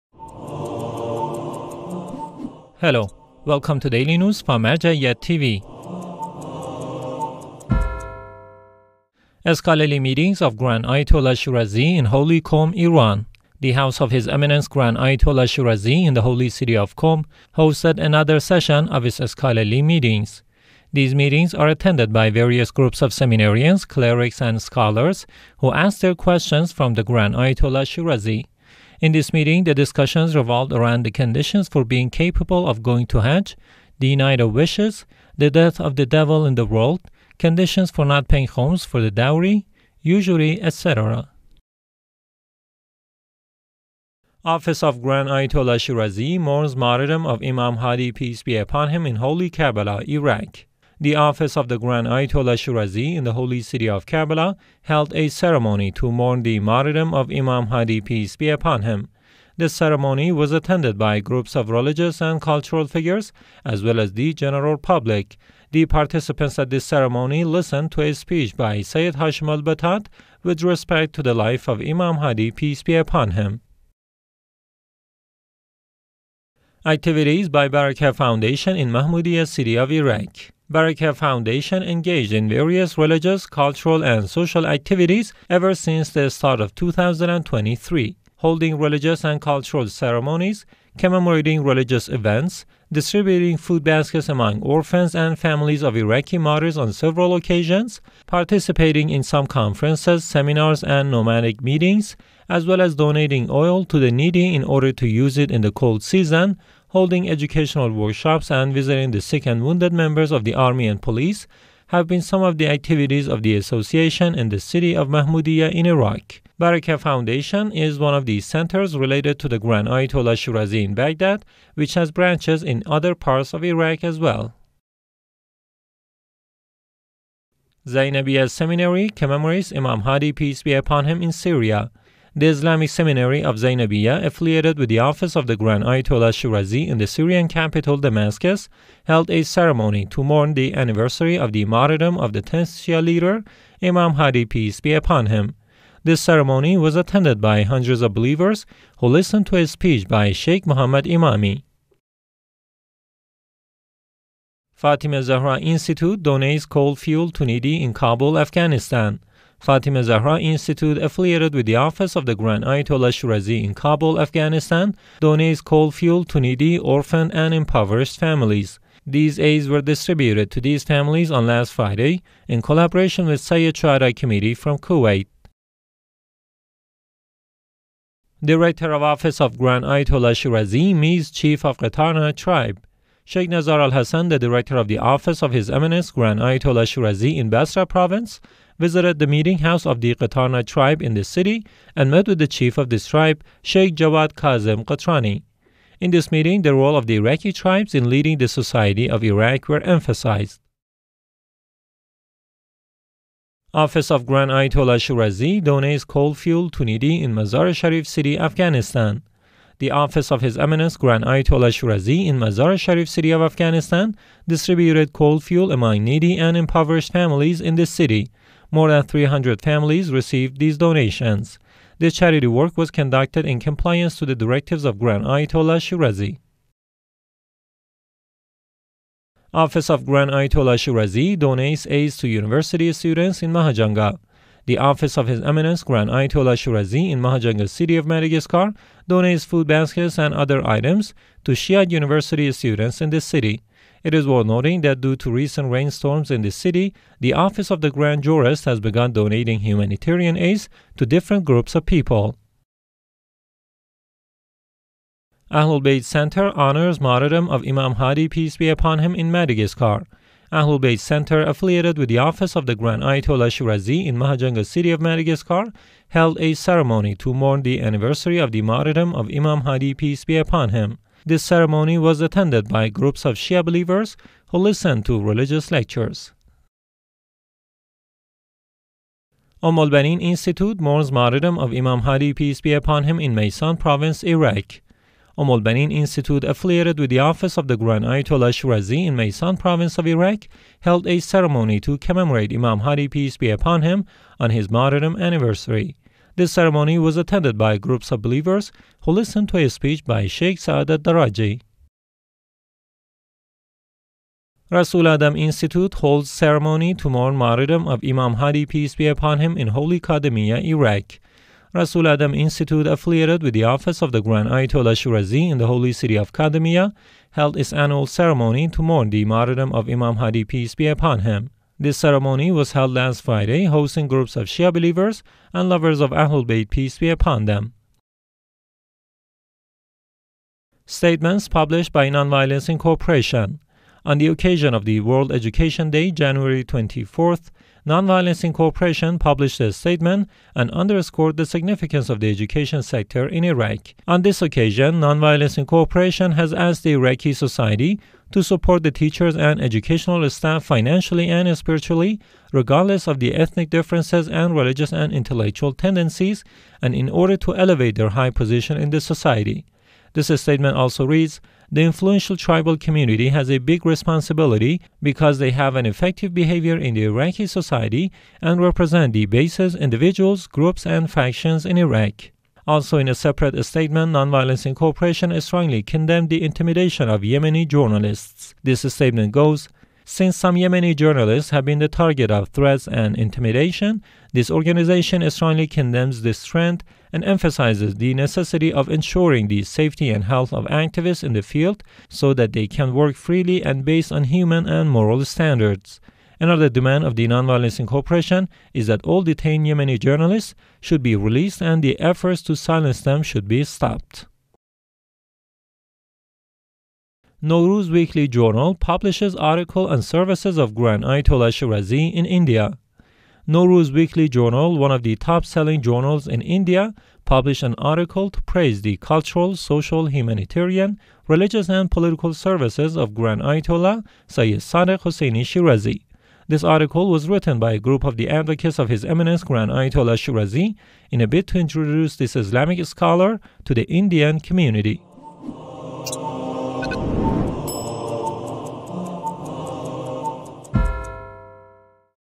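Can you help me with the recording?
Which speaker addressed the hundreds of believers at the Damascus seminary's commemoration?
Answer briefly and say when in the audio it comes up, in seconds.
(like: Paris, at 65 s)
Sheikh Muhammad Imami, at 150 s.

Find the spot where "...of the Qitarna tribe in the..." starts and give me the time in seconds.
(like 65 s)
189 s.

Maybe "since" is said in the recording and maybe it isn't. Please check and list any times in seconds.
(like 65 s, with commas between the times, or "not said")
85 s, 380 s.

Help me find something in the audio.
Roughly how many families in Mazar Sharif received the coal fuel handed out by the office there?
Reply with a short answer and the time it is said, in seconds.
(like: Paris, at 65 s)
300, at 219 s.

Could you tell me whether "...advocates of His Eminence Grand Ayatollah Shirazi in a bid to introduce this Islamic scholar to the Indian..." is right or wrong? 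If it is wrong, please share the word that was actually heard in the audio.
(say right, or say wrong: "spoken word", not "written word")
right.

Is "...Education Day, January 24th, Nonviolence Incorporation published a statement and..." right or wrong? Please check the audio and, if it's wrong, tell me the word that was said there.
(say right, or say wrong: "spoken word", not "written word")
right.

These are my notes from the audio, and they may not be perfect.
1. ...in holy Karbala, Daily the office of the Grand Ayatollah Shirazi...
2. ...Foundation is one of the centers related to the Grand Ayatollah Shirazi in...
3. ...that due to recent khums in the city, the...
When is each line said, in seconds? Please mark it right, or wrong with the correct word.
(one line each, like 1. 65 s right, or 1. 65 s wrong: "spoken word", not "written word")
1. 49 s wrong: "Iraq", not "Daily"
2. 116 s right
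3. 244 s wrong: "rainstorms", not "khums".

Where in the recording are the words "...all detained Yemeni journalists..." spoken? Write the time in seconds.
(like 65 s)
399 s.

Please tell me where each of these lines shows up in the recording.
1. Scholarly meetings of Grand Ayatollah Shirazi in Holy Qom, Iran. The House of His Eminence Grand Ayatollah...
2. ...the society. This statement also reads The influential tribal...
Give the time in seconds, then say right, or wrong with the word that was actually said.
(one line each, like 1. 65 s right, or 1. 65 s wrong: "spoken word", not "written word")
1. 9 s right
2. 358 s right.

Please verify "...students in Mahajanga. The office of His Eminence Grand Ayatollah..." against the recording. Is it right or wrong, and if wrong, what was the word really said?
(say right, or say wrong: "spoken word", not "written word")
right.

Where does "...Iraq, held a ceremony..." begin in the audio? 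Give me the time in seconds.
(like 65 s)
290 s.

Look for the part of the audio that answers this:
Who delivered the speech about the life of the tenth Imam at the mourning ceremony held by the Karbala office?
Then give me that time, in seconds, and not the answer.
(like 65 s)
68 s.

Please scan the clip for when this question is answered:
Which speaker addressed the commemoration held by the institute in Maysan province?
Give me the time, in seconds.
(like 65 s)
300 s.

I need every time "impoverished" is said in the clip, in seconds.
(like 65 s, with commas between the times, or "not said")
167 s, 216 s.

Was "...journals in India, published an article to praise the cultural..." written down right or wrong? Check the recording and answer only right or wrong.
right.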